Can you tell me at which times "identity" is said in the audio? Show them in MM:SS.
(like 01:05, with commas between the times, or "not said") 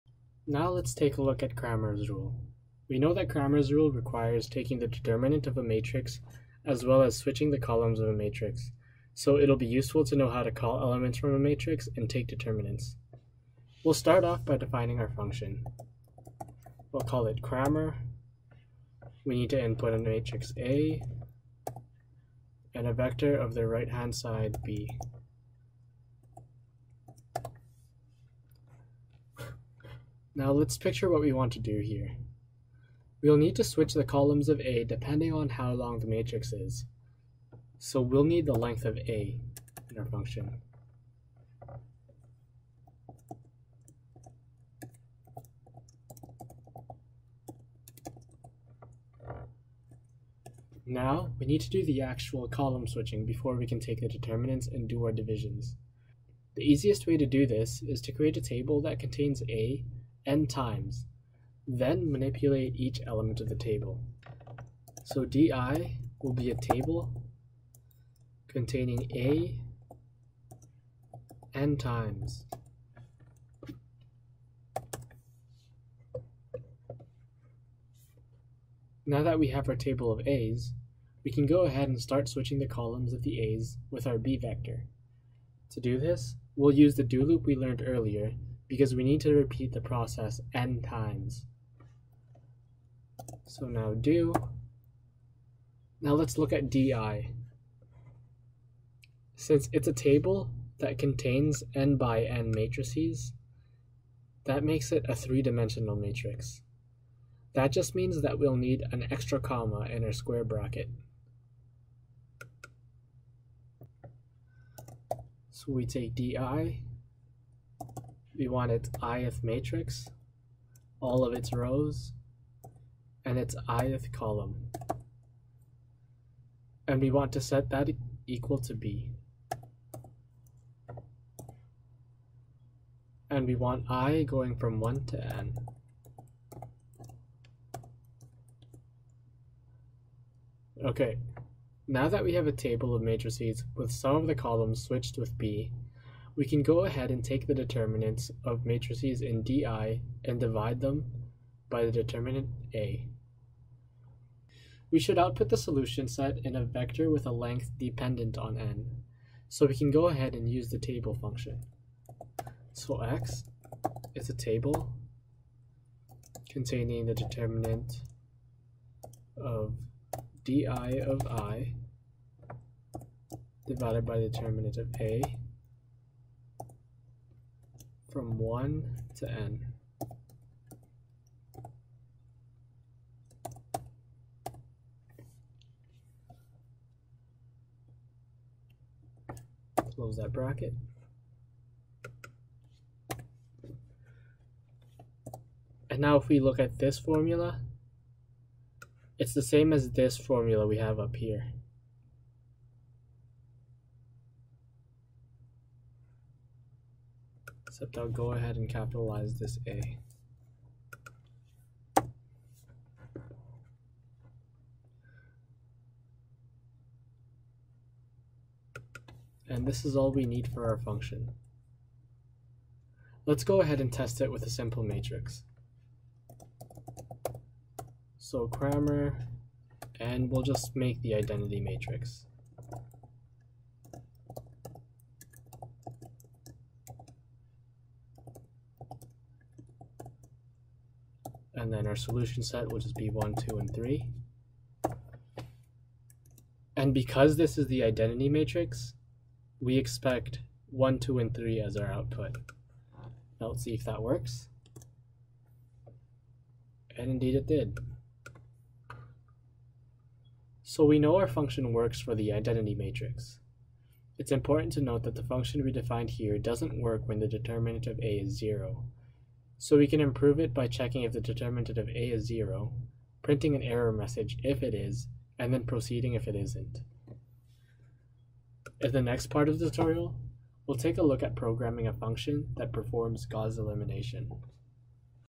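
03:51, 04:07, 04:22.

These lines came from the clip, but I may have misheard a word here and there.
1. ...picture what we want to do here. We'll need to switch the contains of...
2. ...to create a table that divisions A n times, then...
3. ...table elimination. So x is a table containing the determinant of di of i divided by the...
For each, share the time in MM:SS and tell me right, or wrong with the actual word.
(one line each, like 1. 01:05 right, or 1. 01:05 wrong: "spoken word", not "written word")
1. 00:30 wrong: "columns", not "contains"
2. 00:58 wrong: "contains", not "divisions"
3. 02:40 wrong: "function", not "elimination".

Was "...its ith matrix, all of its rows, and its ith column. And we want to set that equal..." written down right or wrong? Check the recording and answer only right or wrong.
right.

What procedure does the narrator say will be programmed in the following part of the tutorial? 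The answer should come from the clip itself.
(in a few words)
Gauss elimination.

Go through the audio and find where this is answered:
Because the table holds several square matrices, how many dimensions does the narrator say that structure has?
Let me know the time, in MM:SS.
01:45.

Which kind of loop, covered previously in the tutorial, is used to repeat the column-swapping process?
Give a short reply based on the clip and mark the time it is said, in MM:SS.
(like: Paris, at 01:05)
do loop, at 01:27.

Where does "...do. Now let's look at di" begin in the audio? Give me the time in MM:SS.
01:33.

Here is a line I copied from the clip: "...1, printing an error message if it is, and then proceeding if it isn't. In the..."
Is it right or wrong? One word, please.
wrong.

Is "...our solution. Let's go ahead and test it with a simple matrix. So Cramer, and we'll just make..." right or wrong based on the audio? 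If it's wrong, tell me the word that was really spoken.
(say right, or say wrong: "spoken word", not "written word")
wrong: "function", not "solution".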